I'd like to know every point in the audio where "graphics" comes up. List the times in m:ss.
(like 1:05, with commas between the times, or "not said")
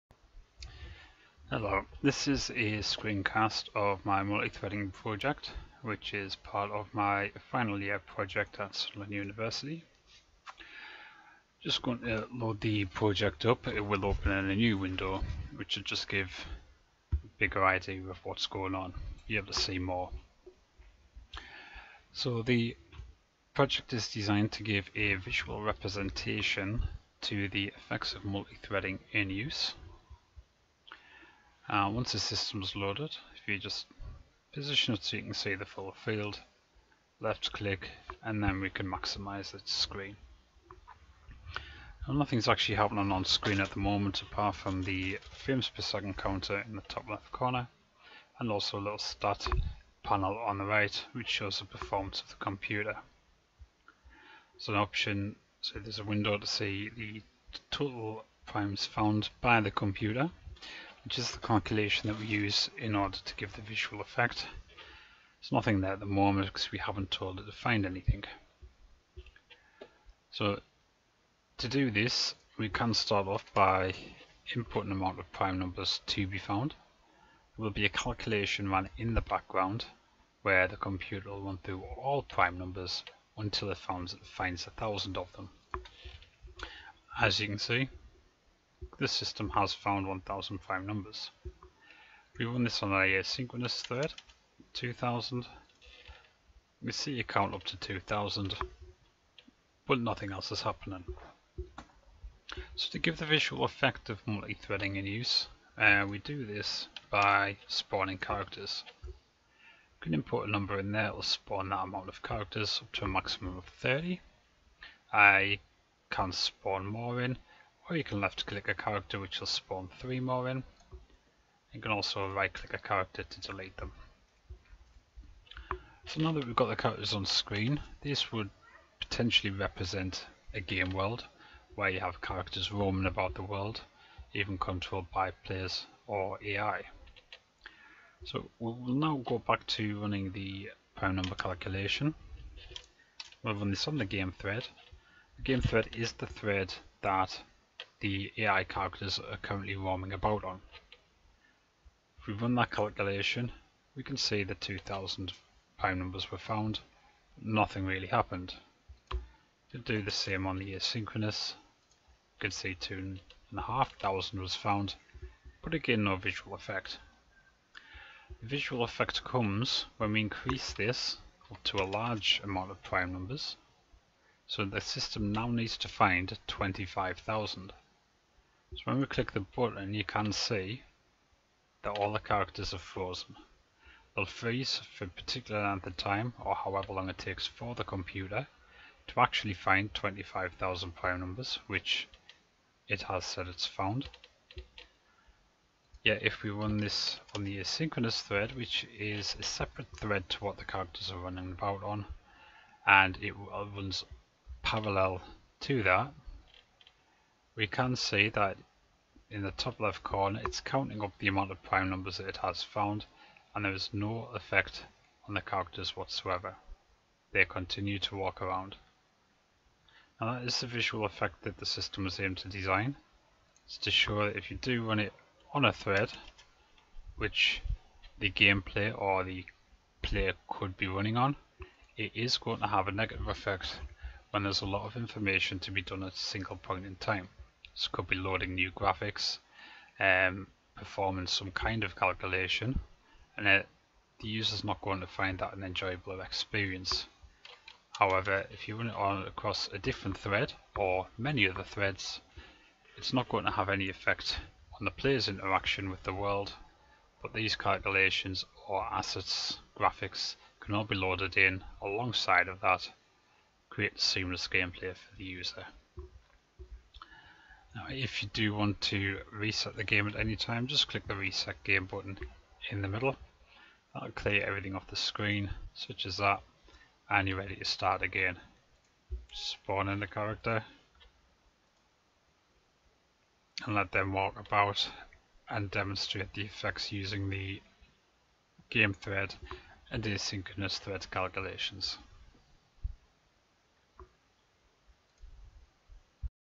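3:58, 4:19.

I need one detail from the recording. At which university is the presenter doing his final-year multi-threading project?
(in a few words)
Sunderland University.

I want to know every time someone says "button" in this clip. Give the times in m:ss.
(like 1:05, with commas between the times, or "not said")
2:59, 4:31.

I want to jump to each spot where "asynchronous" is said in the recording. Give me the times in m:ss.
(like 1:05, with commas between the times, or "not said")
2:40, 3:17, 4:50.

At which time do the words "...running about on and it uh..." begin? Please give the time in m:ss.
3:21.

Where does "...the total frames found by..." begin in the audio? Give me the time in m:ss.
0:56.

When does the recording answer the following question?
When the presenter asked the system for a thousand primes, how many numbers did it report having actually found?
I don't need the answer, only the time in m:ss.
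1:30.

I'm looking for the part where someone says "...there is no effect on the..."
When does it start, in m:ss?
3:33.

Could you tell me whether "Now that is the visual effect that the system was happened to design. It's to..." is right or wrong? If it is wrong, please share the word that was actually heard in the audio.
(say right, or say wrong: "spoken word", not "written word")
wrong: "aimed", not "happened".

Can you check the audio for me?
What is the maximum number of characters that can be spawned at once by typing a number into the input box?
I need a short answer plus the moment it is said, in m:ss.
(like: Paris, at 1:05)
30, at 1:53.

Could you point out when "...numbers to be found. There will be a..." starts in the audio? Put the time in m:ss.
1:15.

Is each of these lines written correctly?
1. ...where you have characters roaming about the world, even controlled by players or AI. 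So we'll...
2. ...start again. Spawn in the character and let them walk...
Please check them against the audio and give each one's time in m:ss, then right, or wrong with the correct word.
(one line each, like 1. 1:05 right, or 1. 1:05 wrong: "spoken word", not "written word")
1. 2:11 right
2. 4:37 right.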